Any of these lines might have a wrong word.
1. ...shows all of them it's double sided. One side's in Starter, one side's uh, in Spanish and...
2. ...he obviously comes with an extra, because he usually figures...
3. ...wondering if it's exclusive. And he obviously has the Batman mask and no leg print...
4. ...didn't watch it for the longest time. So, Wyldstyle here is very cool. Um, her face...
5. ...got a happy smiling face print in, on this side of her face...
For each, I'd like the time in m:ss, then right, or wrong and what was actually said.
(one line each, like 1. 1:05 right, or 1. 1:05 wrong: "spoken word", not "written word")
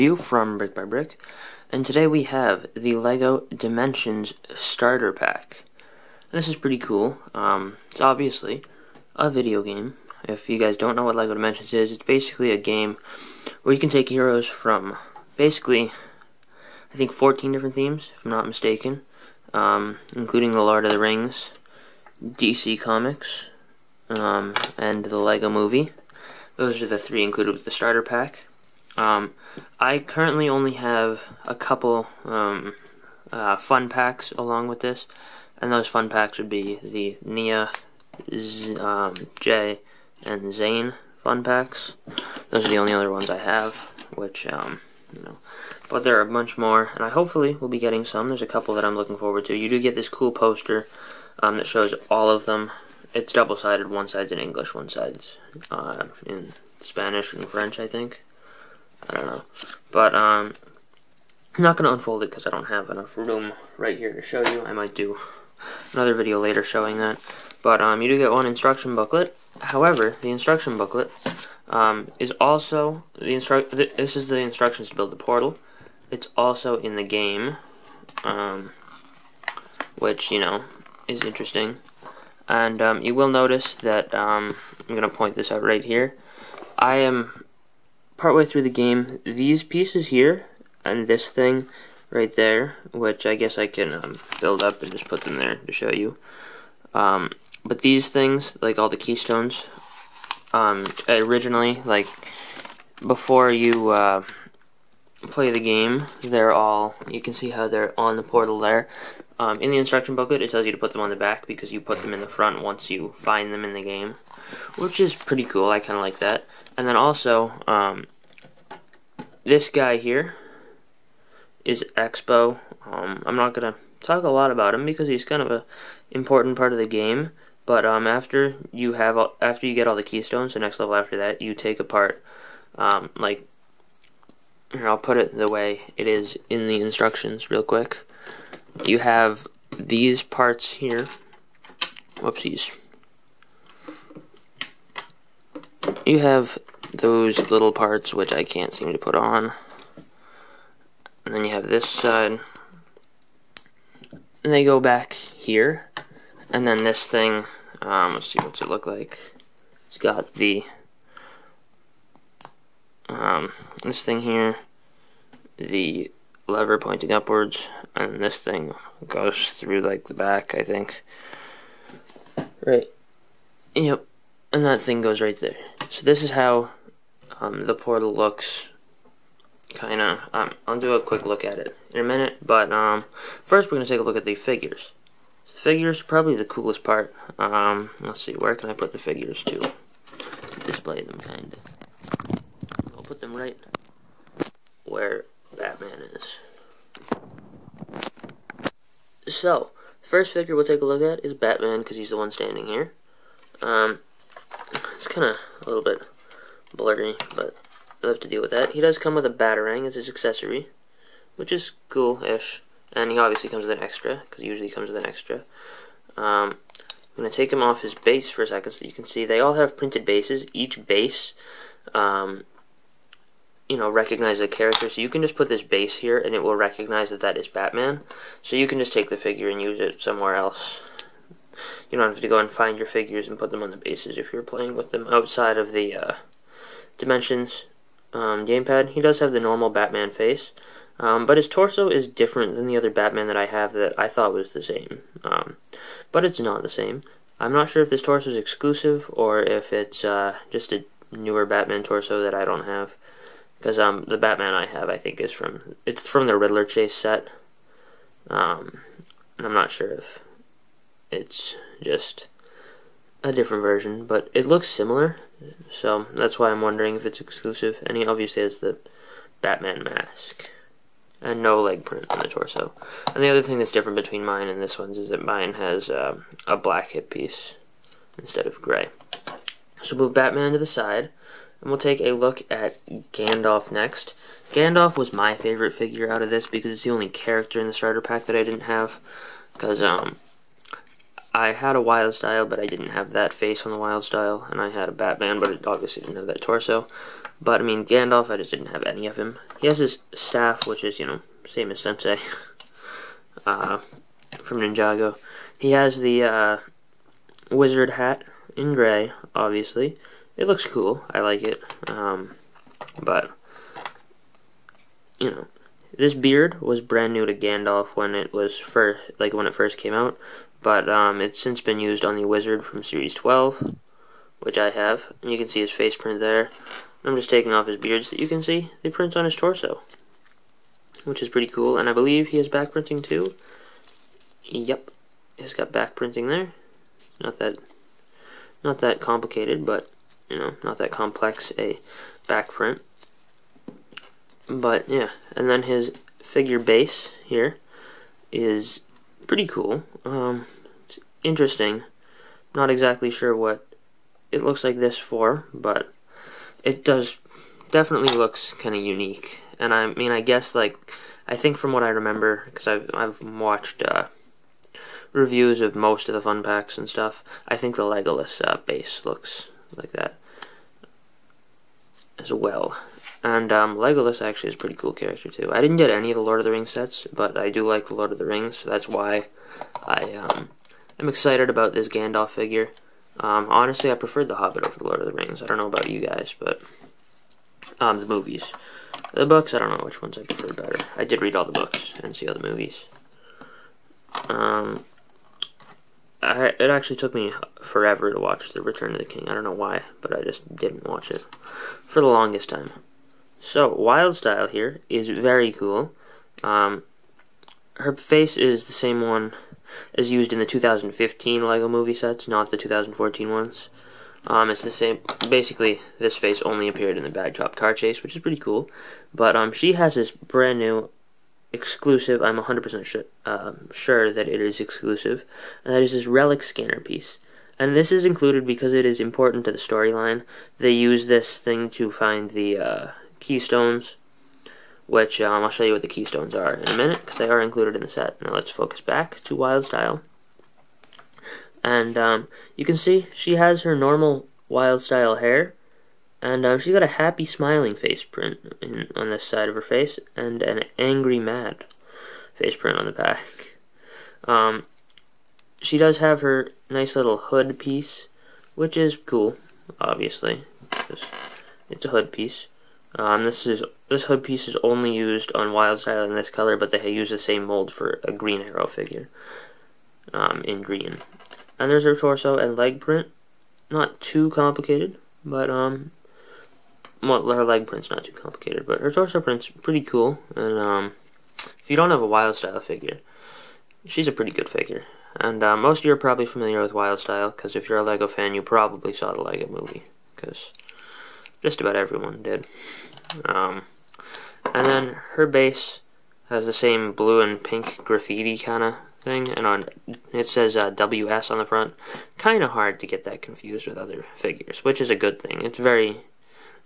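1. 0:51 wrong: "English", not "Starter"
2. 3:33 wrong: "comes", not "figures"
3. 4:26 right
4. 6:40 right
5. 7:26 right.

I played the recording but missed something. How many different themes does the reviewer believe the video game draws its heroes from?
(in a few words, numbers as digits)
14.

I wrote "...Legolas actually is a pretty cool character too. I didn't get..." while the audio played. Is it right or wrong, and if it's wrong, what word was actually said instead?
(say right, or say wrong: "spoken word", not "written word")
right.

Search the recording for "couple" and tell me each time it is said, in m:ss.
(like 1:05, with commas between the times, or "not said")
0:31, 0:48.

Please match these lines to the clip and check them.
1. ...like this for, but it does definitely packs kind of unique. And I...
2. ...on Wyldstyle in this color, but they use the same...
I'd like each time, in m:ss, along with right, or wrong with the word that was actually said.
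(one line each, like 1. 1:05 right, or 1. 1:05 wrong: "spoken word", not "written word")
1. 5:54 wrong: "looks", not "packs"
2. 7:45 right.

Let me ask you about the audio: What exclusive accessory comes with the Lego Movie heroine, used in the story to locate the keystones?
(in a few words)
relic scanner.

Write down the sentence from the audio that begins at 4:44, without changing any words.
Gandalf was my favorite figure out of this because it's the only character in the starter pack that I didn't have.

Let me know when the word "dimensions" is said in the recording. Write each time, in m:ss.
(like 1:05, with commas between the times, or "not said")
0:03, 0:11, 3:56.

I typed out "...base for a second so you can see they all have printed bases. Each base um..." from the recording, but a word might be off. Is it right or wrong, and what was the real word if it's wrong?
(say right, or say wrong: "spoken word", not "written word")
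right.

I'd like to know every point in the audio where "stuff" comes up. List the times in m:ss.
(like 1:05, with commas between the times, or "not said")
6:06.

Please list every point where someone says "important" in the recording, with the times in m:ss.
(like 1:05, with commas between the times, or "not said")
2:06, 7:08.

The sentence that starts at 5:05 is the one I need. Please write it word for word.
He has the uh, wizard hat in gray, obviously it looks cool.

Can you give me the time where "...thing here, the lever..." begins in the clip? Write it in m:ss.
2:44.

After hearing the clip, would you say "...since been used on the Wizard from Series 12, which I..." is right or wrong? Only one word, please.
right.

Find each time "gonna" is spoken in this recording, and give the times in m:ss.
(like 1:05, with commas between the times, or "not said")
1:24, 3:03.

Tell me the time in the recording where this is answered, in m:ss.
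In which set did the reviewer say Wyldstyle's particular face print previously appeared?
6:57.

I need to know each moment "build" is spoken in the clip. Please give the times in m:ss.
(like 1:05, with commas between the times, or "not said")
1:14, 1:34.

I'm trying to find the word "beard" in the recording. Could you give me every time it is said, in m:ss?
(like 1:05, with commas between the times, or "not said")
5:16, 5:27.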